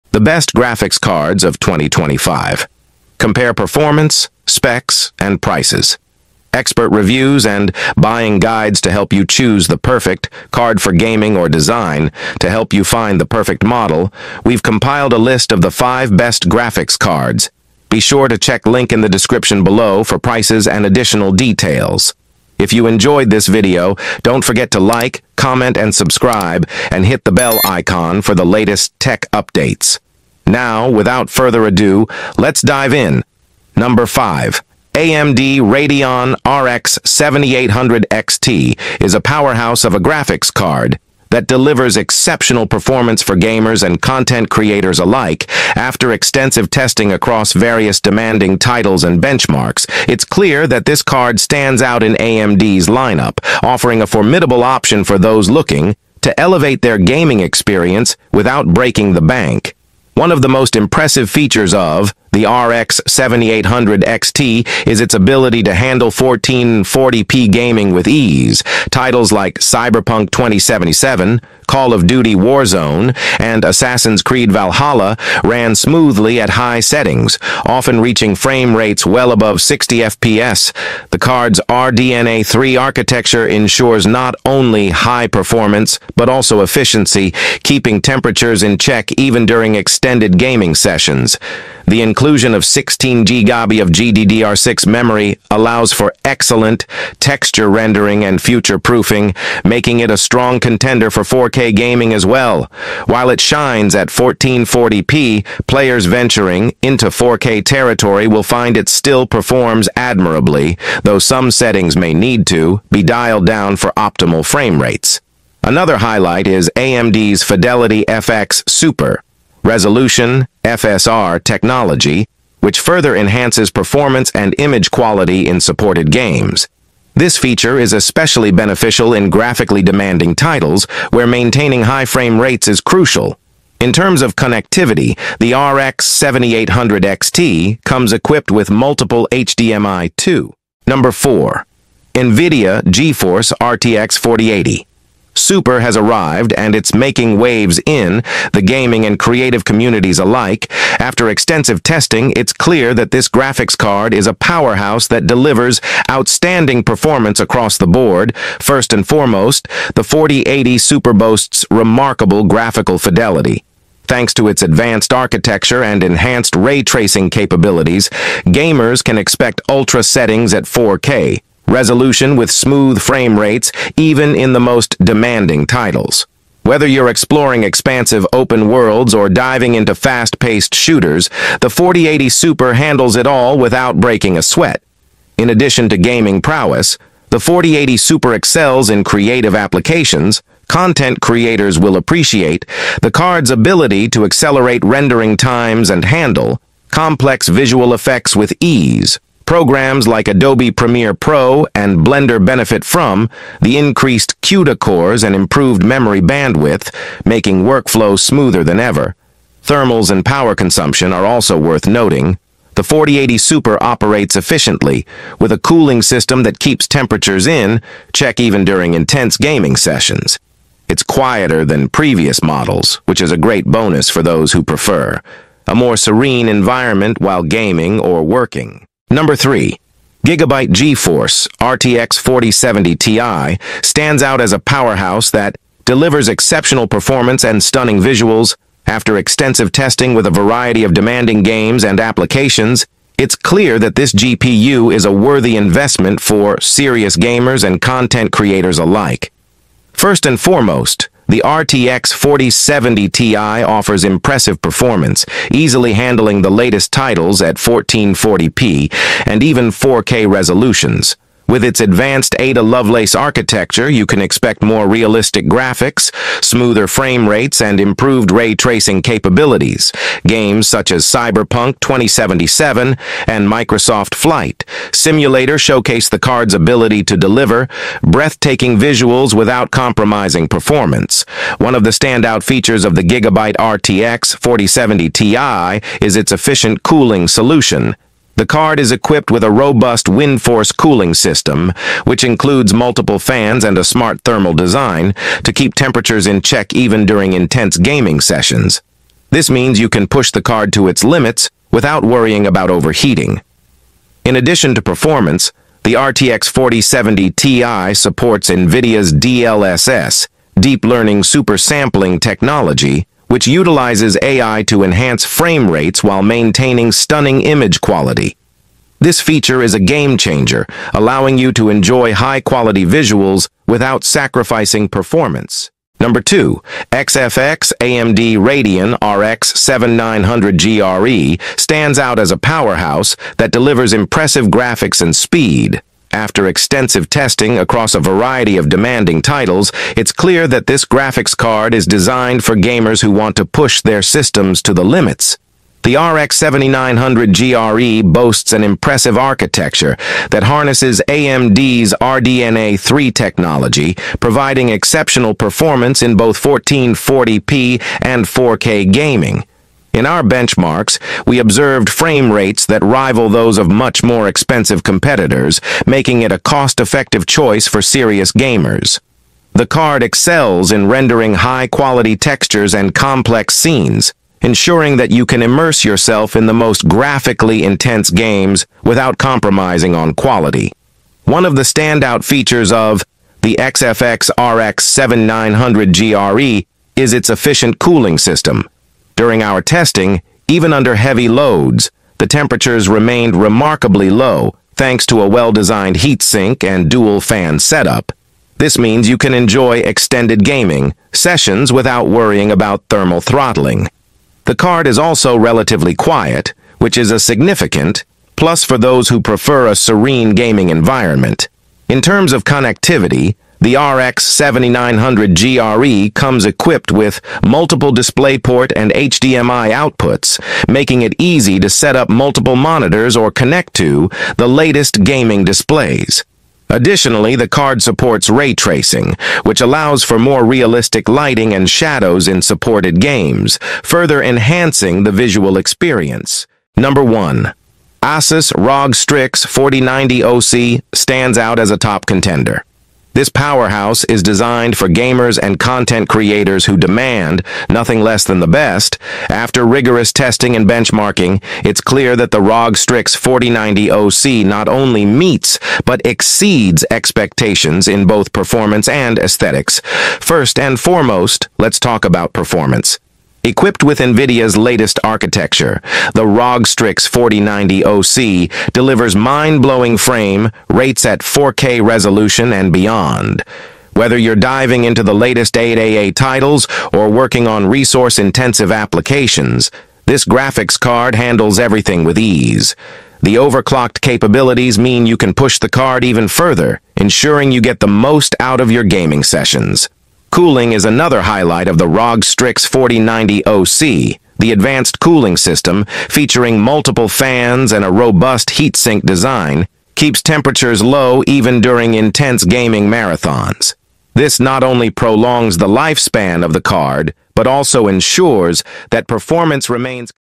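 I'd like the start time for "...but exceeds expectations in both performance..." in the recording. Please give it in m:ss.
7:35.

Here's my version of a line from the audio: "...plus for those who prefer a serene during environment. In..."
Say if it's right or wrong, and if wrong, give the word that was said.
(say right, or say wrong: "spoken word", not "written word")
wrong: "gaming", not "during".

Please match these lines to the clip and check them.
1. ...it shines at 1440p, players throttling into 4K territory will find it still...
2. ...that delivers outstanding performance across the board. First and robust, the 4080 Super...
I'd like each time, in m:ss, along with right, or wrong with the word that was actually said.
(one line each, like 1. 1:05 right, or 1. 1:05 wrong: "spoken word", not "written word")
1. 1:43 wrong: "venturing", not "throttling"
2. 2:35 wrong: "foremost", not "robust".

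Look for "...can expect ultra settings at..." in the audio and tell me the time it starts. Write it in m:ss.
2:49.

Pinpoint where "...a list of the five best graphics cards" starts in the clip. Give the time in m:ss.
0:15.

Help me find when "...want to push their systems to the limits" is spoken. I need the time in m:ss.
5:43.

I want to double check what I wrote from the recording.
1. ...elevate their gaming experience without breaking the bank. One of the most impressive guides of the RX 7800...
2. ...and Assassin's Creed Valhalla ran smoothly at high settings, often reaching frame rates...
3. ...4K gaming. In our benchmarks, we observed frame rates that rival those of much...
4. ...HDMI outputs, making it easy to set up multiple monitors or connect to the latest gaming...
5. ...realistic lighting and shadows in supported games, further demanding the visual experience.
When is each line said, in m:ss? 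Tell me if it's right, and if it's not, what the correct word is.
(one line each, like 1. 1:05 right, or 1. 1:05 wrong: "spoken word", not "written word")
1. 0:56 wrong: "features", not "guides"
2. 1:13 right
3. 5:58 right
4. 6:58 right
5. 7:10 wrong: "enhancing", not "demanding".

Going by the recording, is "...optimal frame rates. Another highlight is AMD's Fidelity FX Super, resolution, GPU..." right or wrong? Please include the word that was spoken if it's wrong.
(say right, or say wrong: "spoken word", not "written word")
wrong: "FSR", not "GPU".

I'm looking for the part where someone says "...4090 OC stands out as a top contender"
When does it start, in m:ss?
7:19.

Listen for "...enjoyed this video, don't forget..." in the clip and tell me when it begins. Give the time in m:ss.
0:22.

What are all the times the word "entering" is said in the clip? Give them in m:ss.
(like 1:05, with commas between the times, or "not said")
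not said.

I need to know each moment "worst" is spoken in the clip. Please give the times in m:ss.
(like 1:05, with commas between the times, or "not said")
not said.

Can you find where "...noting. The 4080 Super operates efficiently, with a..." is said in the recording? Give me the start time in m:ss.
3:31.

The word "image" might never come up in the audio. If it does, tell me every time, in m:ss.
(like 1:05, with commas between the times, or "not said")
2:04, 5:17.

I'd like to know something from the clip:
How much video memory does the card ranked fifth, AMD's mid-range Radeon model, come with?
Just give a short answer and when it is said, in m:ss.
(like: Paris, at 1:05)
16 GB, at 1:32.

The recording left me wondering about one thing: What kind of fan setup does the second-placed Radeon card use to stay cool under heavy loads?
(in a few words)
Dual fan.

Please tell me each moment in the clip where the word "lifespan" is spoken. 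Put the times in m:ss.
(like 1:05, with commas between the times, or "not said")
8:25.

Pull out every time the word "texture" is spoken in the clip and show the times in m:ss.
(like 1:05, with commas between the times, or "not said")
1:37, 6:12.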